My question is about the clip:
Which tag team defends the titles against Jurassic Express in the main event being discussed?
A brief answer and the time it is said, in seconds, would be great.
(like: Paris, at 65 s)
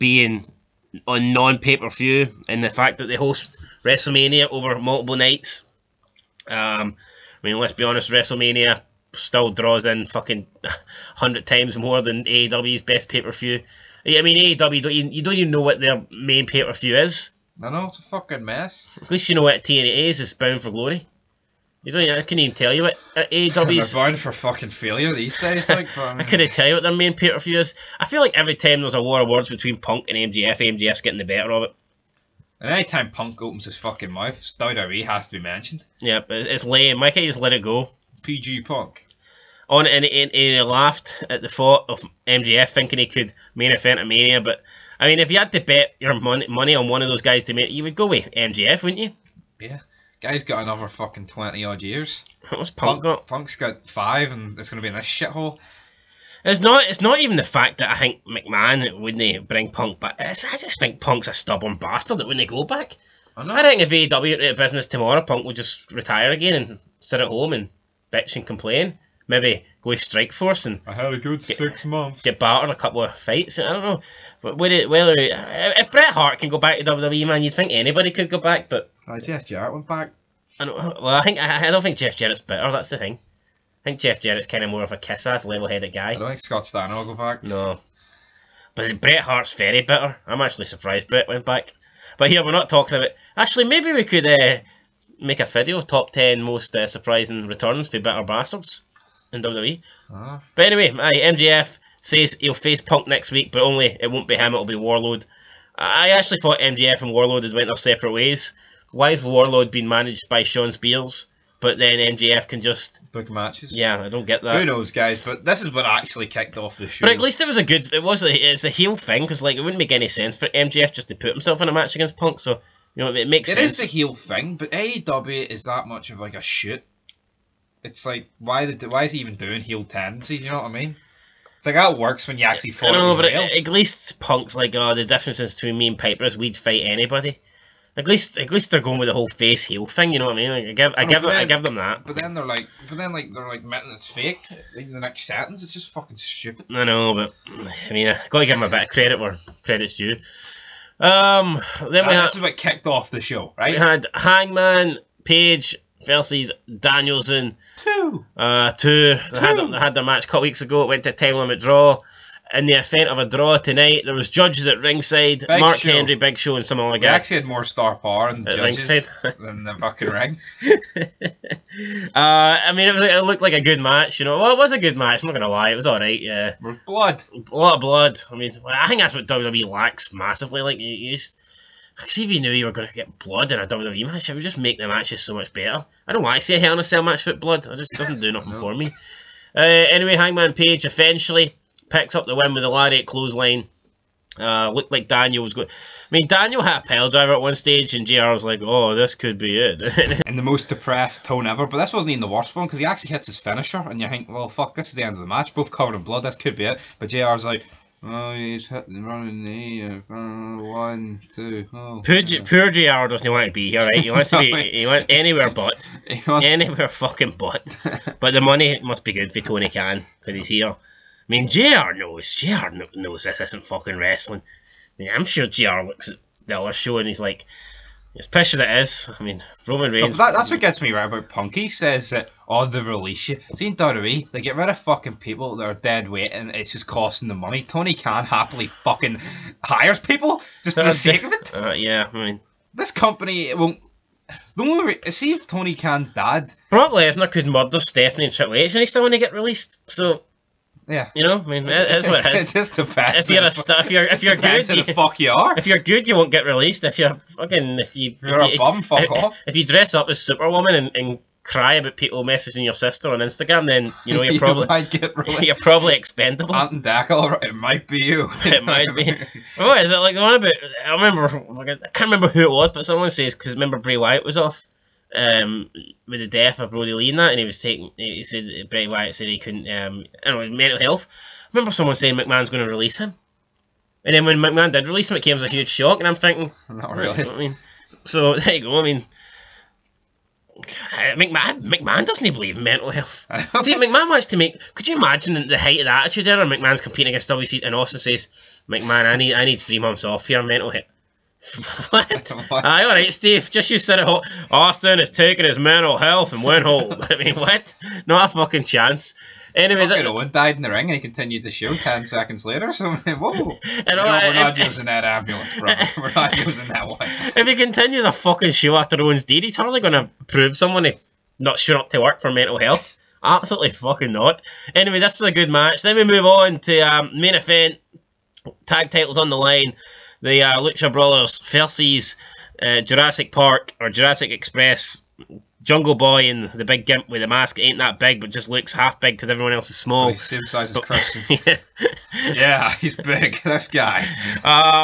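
Lucha Brothers, at 330 s.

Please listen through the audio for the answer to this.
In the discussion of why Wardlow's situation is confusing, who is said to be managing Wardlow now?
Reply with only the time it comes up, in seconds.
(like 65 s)
110 s.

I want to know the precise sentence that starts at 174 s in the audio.
Well, it was a good match.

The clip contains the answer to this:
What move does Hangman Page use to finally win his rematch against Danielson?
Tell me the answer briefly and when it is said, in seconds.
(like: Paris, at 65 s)
Lariat clothesline, at 192 s.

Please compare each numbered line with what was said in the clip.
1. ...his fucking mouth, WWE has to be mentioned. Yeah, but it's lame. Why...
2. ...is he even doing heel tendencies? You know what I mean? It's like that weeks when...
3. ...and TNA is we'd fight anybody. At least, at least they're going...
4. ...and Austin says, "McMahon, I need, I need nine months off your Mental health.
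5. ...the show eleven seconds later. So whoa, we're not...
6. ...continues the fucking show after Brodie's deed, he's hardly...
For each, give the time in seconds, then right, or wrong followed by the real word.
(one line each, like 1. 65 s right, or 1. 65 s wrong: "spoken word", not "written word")
1. 33 s right
2. 129 s wrong: "works", not "weeks"
3. 135 s wrong: "Piper", not "TNA"
4. 297 s wrong: "three", not "nine"
5. 311 s wrong: "ten", not "eleven"
6. 317 s wrong: "Owen", not "Brodie".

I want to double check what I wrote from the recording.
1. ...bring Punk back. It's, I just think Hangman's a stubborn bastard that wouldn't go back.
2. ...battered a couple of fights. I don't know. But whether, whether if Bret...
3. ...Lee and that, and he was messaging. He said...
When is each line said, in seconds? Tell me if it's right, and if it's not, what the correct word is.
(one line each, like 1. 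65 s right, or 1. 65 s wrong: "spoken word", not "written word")
1. 59 s wrong: "Punk", not "Hangman"
2. 72 s right
3. 276 s wrong: "taking", not "messaging".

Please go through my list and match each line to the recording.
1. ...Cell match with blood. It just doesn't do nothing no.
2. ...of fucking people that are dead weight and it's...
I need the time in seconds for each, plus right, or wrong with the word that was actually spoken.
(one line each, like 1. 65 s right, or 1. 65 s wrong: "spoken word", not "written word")
1. 186 s right
2. 234 s right.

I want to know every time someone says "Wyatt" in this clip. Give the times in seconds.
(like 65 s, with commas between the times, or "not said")
273 s, 278 s.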